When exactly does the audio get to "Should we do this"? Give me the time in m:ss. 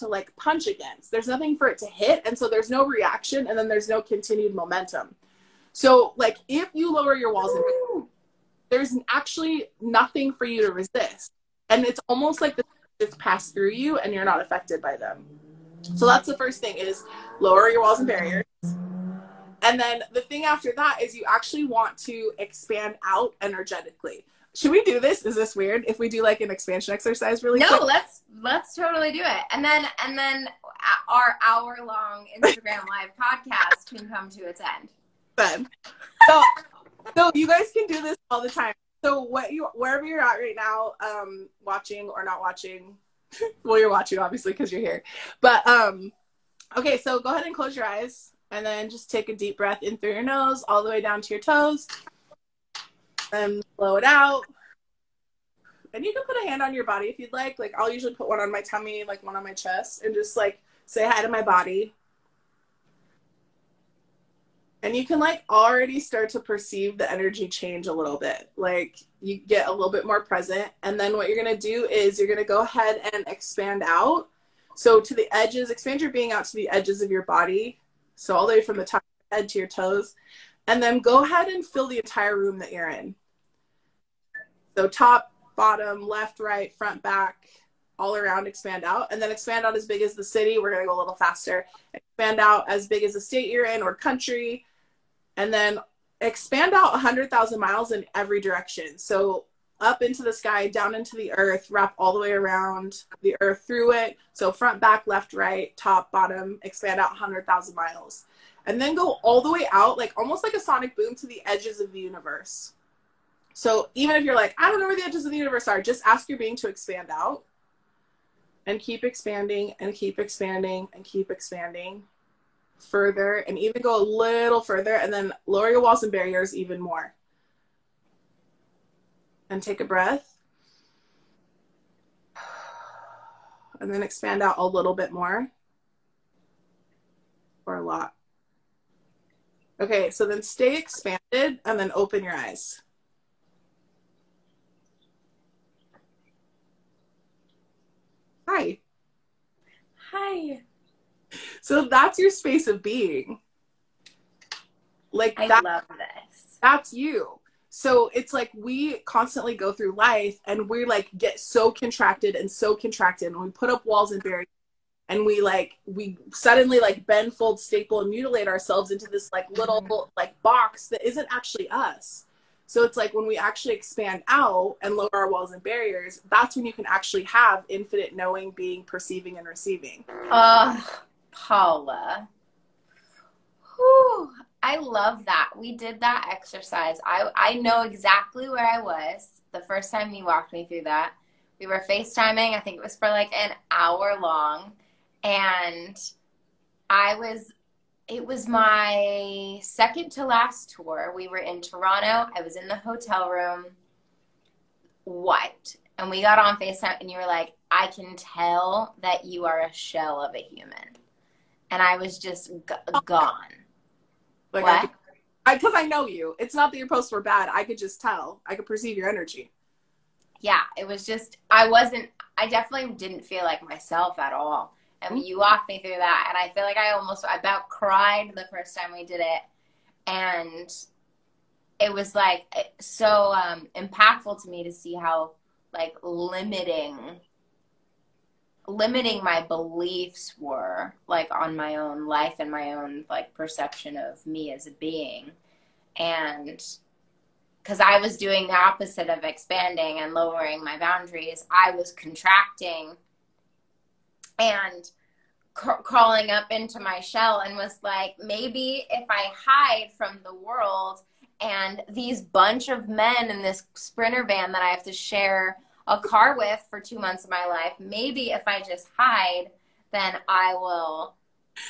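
0:24.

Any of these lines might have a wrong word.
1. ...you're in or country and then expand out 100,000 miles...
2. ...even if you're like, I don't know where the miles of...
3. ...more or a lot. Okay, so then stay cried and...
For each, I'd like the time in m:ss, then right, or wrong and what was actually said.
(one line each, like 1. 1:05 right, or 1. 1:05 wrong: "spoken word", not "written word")
1. 1:33 right
2. 1:53 wrong: "edges", not "miles"
3. 2:15 wrong: "expanded", not "cried".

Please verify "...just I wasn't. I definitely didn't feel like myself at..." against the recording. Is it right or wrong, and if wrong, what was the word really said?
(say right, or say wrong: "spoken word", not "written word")
right.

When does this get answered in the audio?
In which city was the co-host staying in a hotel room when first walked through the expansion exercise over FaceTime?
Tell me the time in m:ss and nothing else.
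3:21.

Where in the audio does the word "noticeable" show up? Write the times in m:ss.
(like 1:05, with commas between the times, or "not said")
not said.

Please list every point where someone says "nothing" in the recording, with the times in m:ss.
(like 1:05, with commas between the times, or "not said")
0:01, 0:09.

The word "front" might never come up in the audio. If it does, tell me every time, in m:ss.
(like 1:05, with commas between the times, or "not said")
1:26, 1:44.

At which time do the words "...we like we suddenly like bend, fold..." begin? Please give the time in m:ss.
2:45.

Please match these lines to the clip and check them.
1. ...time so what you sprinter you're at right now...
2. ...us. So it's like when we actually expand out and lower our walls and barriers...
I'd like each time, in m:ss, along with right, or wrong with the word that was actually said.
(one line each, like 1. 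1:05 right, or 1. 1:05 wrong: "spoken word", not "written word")
1. 0:38 wrong: "wherever", not "sprinter"
2. 2:51 right.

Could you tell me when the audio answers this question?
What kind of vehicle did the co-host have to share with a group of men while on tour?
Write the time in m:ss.
4:23.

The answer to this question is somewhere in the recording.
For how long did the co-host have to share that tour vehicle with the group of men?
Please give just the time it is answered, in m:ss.
4:26.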